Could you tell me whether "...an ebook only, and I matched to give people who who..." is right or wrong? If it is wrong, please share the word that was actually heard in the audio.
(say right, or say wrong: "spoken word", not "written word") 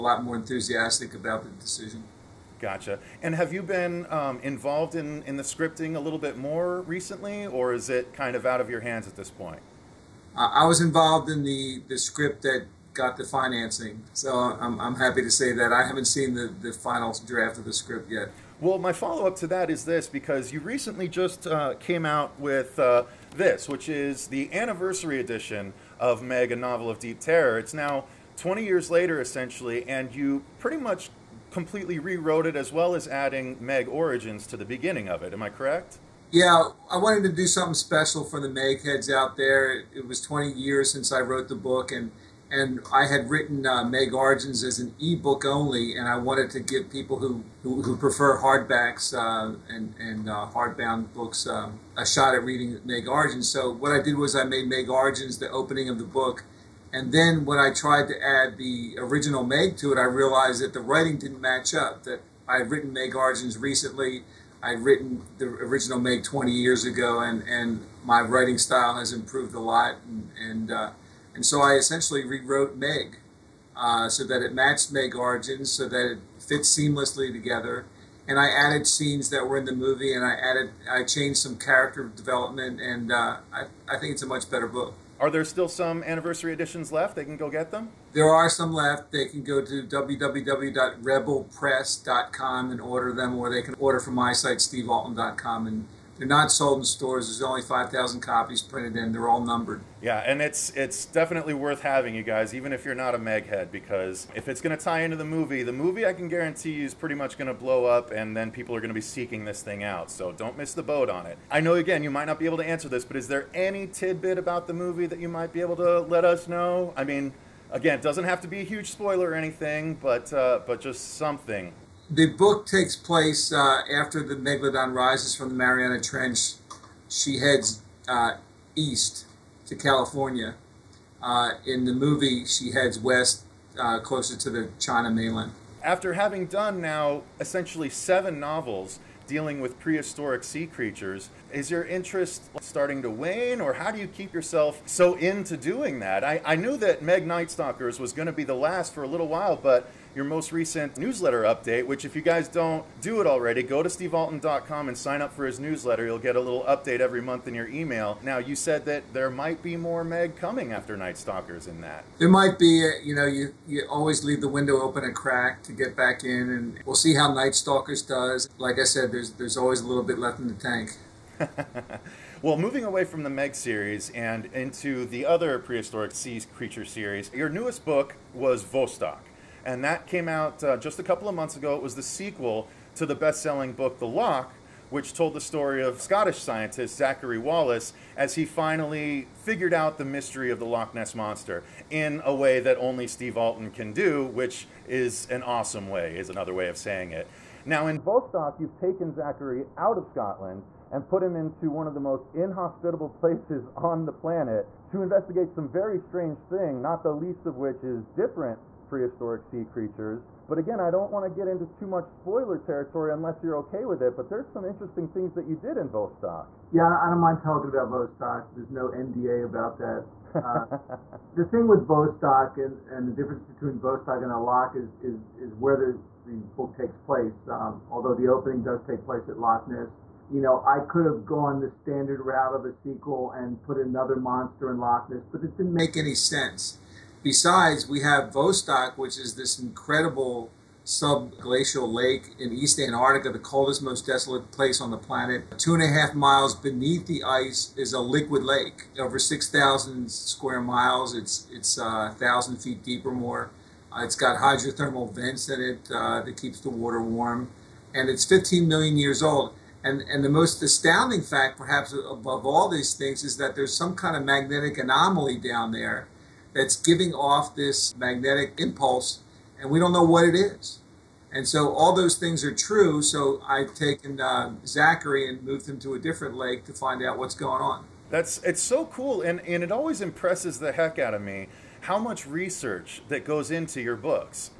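wrong: "wanted", not "matched".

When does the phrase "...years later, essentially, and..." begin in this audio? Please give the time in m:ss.
0:28.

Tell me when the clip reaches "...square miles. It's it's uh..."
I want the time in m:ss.
4:10.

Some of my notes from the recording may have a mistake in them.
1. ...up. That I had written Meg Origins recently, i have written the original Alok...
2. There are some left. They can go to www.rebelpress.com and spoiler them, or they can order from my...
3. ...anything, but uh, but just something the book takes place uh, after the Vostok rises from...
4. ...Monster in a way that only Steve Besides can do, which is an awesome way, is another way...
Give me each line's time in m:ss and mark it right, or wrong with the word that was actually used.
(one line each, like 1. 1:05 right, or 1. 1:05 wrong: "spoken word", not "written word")
1. 1:01 wrong: "Meg", not "Alok"
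2. 1:28 wrong: "order", not "spoiler"
3. 1:59 wrong: "Megalodon", not "Vostok"
4. 3:11 wrong: "Alten", not "Besides".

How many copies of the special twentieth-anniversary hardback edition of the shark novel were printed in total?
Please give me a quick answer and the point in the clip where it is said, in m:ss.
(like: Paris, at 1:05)
5,000, at 1:37.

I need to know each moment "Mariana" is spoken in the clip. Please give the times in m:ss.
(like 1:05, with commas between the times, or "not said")
2:05.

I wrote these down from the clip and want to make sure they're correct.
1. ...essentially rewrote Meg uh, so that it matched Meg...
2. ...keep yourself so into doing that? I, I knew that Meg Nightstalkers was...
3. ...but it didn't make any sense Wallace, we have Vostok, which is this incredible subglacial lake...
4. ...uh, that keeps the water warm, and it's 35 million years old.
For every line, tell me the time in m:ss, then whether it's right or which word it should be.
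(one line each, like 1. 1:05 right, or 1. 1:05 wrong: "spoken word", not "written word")
1. 1:11 right
2. 2:24 right
3. 3:55 wrong: "Besides", not "Wallace"
4. 4:15 wrong: "15", not "35".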